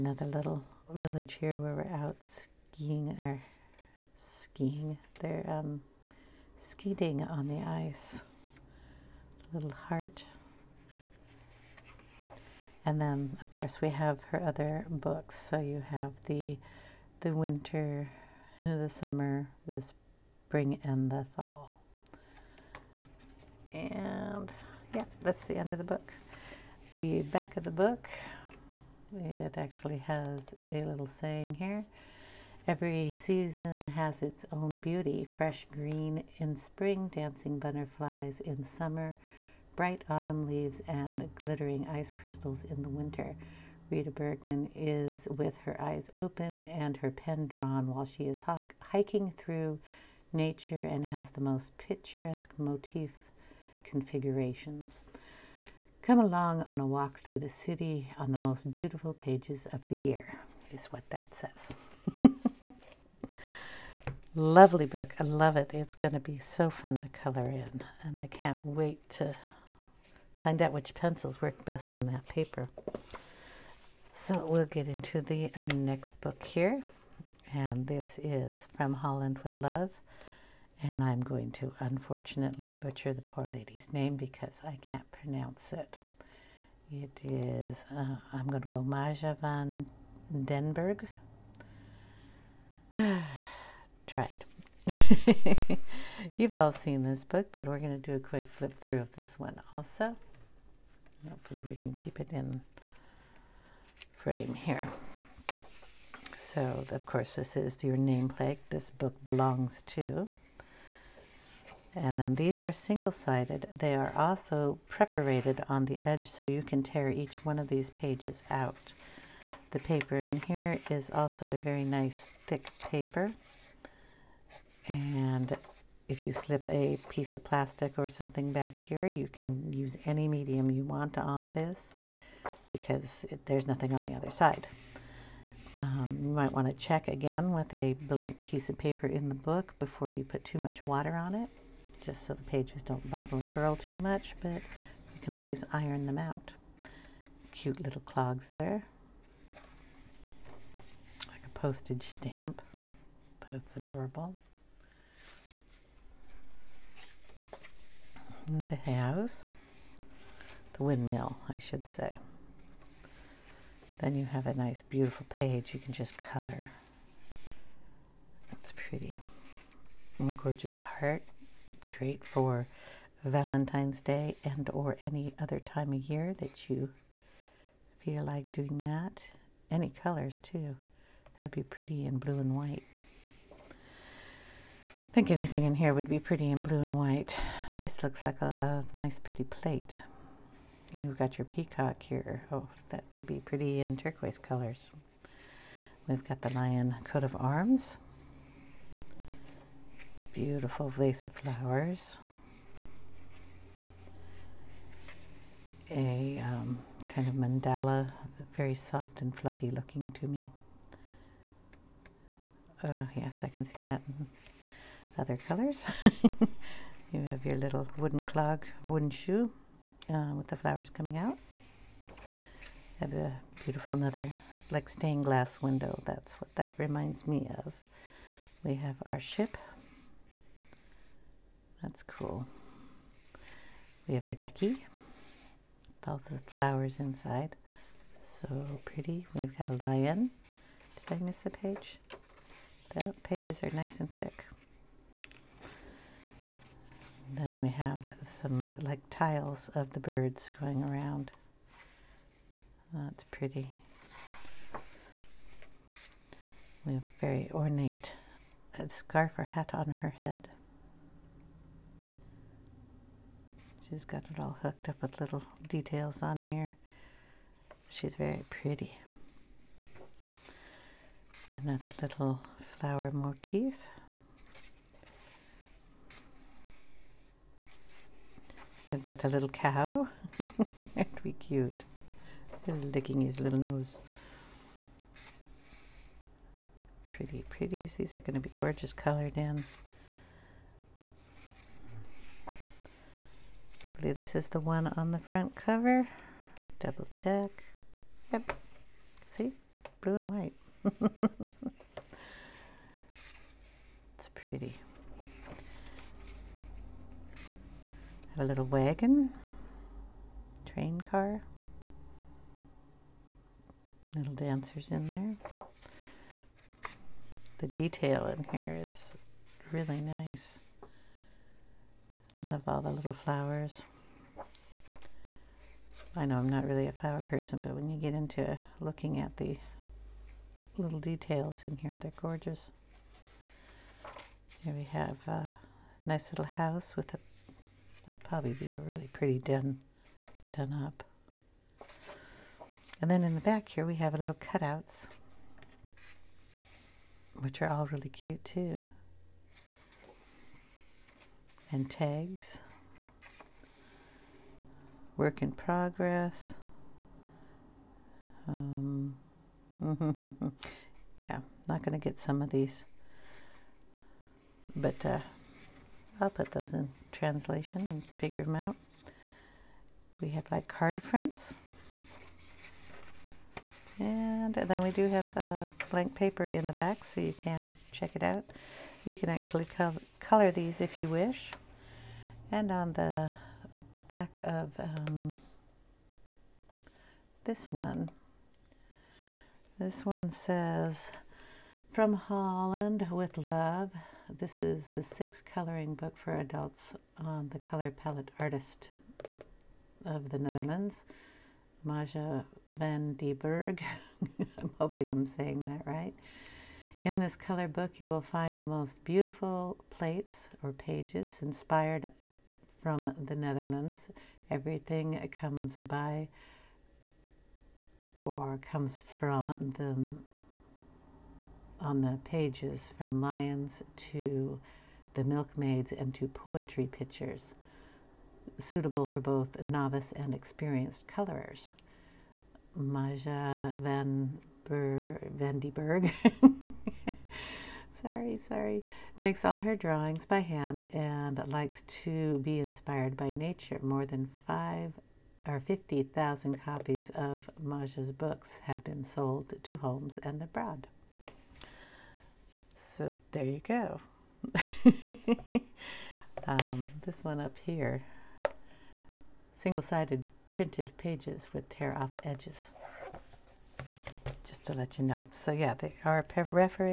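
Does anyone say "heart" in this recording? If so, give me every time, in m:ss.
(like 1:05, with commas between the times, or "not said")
0:09, 2:50.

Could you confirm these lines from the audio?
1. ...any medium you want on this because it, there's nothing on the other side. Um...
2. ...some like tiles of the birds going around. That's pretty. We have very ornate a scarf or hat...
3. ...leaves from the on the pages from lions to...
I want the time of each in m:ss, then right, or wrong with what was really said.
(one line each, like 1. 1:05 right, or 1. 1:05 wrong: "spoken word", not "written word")
1. 2:10 right
2. 4:08 right
3. 6:58 wrong: "comes", not "leaves".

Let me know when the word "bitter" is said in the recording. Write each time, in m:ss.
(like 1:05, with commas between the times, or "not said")
not said.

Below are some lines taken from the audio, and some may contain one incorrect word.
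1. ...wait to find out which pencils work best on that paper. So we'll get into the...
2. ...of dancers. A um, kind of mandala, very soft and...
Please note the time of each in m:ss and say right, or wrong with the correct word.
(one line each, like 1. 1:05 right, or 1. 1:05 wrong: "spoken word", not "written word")
1. 1:08 right
2. 3:21 wrong: "flowers", not "dancers".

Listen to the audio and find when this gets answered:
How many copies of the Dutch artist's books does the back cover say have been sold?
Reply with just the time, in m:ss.
7:25.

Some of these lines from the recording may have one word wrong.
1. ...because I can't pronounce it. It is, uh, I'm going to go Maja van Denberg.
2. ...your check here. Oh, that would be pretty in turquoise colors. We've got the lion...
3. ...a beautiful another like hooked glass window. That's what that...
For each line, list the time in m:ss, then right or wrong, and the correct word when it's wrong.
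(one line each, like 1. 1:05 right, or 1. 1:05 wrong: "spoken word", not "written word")
1. 1:24 right
2. 3:11 wrong: "peacock", not "check"
3. 3:43 wrong: "stained", not "hooked".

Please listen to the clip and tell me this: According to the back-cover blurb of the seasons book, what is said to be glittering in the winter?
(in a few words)
ice crystals.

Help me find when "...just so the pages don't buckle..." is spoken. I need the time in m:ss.
2:22.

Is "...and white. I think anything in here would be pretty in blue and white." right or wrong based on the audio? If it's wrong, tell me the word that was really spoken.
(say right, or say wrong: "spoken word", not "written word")
right.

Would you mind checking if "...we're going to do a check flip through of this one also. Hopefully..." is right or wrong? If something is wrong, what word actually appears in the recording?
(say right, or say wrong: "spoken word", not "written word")
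wrong: "quick", not "check".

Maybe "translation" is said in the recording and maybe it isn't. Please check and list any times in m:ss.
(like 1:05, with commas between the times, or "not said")
6:07.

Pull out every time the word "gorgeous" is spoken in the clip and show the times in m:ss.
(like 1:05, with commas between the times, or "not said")
2:50, 4:48, 5:32.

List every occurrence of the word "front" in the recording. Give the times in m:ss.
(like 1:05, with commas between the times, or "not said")
4:55, 6:11.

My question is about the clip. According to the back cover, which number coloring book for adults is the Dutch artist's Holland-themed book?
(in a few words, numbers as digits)
sixth.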